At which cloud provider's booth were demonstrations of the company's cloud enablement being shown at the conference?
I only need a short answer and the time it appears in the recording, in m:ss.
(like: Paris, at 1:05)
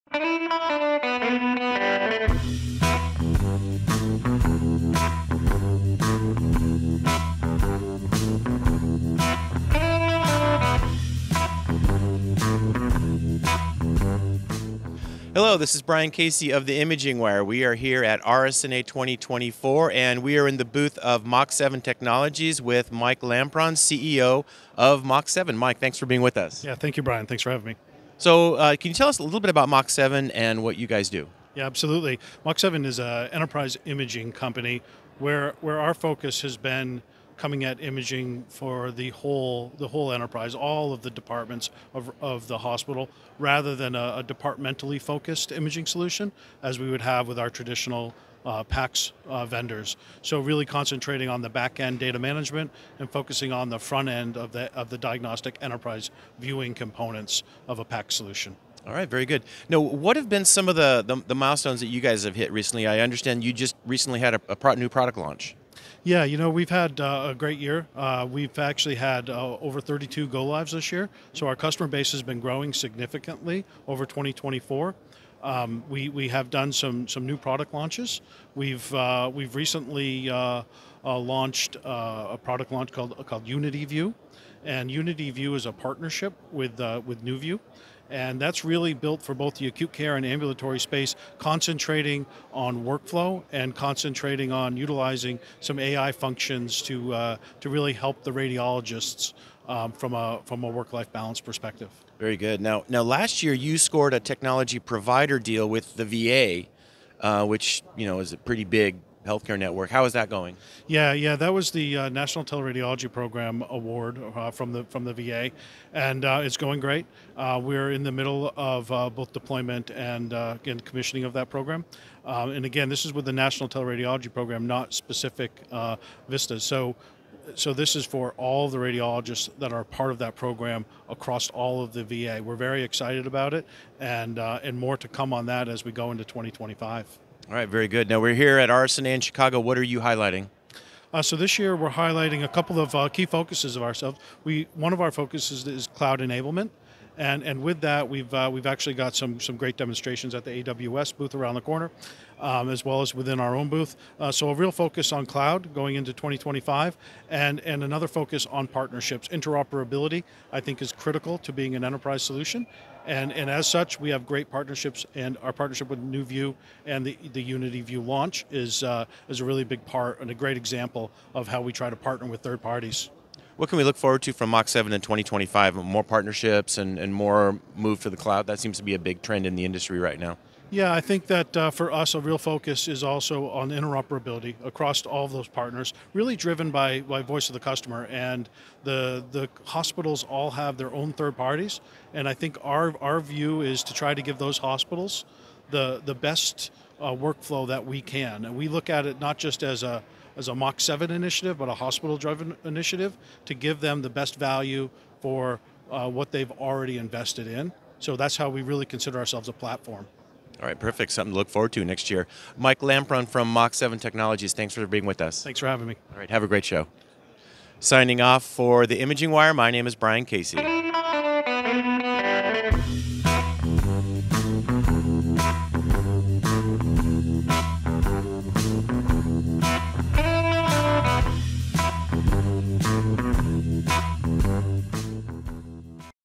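AWS, at 2:30.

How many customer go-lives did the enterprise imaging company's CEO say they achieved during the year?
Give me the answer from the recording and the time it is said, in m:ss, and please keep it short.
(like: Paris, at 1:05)
32, at 1:09.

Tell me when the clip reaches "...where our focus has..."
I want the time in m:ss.
0:35.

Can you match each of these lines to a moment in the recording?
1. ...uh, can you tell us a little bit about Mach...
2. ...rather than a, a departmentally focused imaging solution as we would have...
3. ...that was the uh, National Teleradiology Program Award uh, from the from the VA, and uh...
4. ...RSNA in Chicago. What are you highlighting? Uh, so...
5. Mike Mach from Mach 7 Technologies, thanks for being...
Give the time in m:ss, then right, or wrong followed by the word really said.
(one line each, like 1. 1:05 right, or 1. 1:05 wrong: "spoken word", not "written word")
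1. 0:28 right
2. 0:43 right
3. 1:51 right
4. 2:18 right
5. 3:32 wrong: "Lampron", not "Mach".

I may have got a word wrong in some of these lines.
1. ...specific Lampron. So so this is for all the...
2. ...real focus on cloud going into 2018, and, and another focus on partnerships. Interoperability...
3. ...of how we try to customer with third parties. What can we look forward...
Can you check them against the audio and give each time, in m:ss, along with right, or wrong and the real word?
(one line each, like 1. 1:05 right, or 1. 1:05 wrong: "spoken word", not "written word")
1. 2:04 wrong: "VISNs", not "Lampron"
2. 2:34 wrong: "2025", not "2018"
3. 2:51 wrong: "partner", not "customer".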